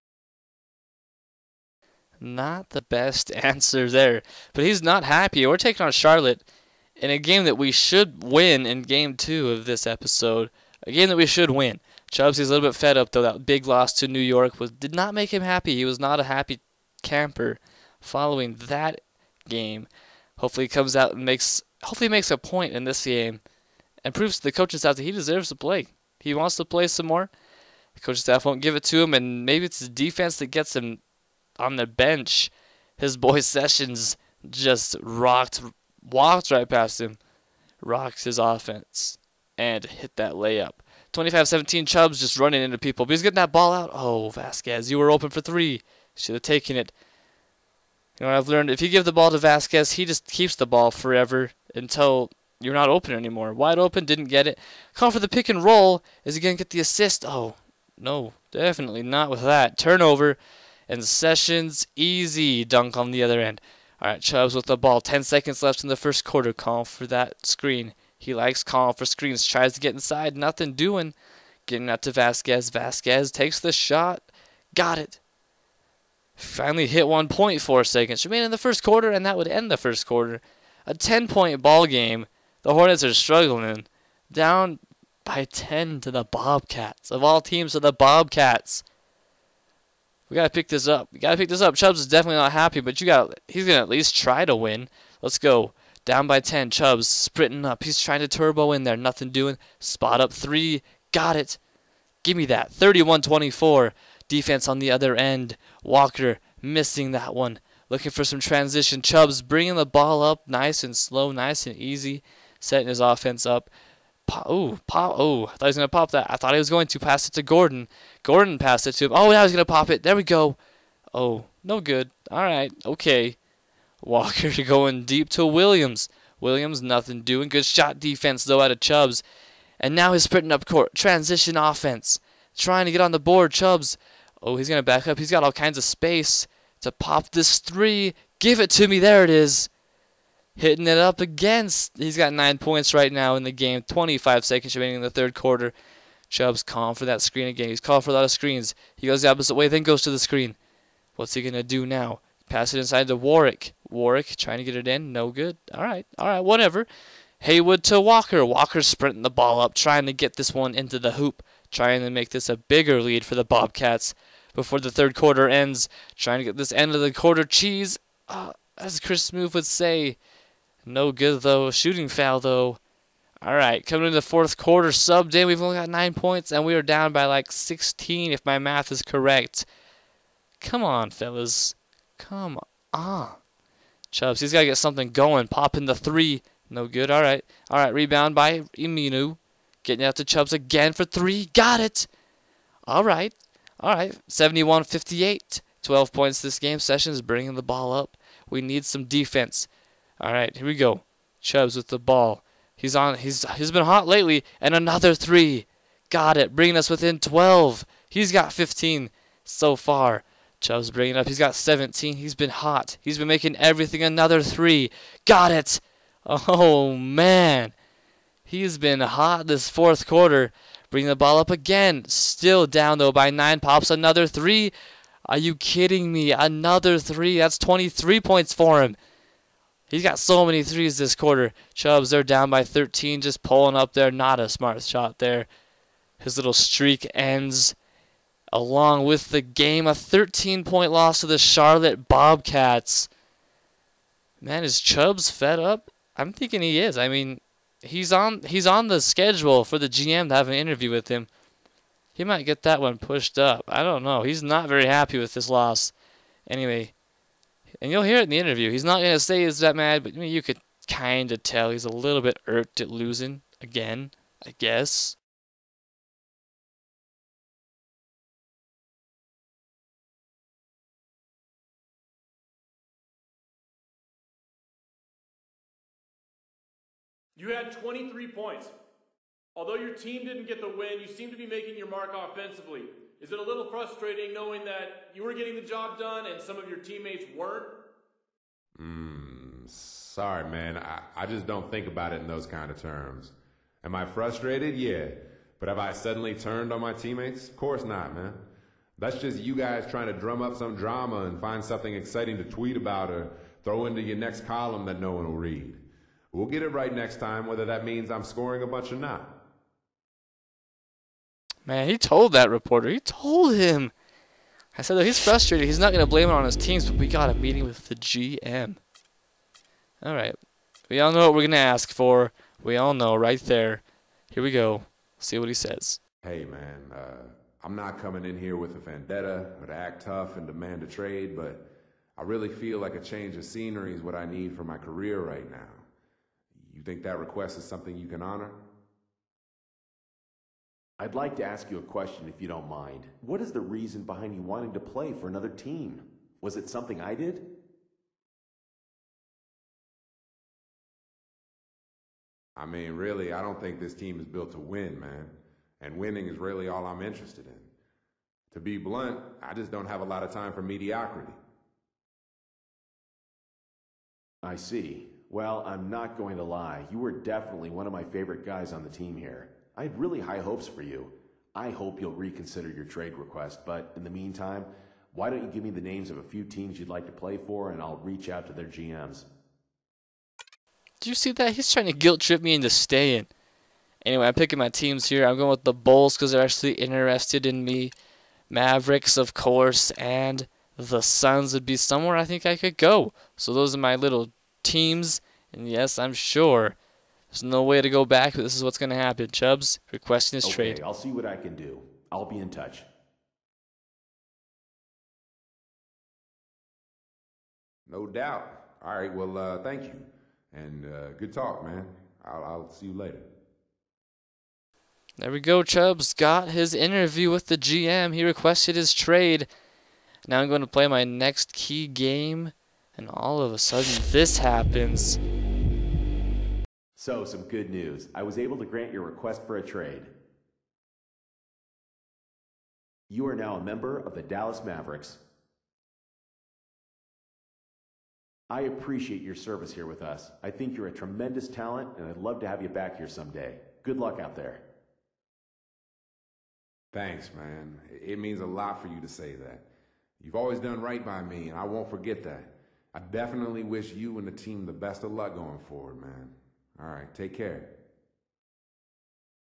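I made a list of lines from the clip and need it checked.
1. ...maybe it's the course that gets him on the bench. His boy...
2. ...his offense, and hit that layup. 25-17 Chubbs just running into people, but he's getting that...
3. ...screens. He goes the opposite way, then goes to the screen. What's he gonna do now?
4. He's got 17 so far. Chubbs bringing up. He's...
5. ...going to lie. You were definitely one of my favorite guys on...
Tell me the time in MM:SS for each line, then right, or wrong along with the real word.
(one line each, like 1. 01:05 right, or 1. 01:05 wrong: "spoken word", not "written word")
1. 00:29 wrong: "defense", not "course"
2. 00:38 right
3. 02:28 right
4. 03:28 wrong: "15", not "17"
5. 06:06 right.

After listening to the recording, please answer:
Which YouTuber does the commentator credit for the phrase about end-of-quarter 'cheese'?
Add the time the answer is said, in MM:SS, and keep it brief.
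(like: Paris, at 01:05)
Chris Smoove, at 02:48.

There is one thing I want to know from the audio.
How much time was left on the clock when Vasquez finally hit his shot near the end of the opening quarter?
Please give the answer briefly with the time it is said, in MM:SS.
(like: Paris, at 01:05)
1.4 seconds, at 01:17.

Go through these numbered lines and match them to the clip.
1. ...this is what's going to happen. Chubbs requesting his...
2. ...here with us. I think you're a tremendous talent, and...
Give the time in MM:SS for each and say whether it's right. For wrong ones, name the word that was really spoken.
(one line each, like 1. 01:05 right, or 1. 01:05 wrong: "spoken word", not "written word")
1. 06:38 right
2. 07:19 right.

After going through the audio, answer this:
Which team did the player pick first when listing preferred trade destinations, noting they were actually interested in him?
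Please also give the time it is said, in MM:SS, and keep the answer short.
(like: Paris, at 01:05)
Bulls, at 06:25.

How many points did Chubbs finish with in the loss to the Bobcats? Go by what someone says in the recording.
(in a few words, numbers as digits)
23.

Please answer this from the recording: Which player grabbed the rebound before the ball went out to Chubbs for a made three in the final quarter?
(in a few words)
Aminu.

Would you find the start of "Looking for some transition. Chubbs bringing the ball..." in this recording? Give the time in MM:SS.
01:47.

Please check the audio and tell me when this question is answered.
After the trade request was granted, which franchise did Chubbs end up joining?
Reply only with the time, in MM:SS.
07:14.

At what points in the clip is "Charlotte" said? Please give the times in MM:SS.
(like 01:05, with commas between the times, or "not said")
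00:05, 04:01.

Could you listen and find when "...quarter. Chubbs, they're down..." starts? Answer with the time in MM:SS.
03:51.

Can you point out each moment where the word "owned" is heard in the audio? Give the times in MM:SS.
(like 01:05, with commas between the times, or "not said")
not said.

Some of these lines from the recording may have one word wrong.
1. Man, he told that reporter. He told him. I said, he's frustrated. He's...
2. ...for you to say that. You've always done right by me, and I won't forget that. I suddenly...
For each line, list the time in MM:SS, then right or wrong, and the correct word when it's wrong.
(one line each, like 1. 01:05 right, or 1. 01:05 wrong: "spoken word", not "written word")
1. 05:11 right
2. 07:28 wrong: "definitely", not "suddenly".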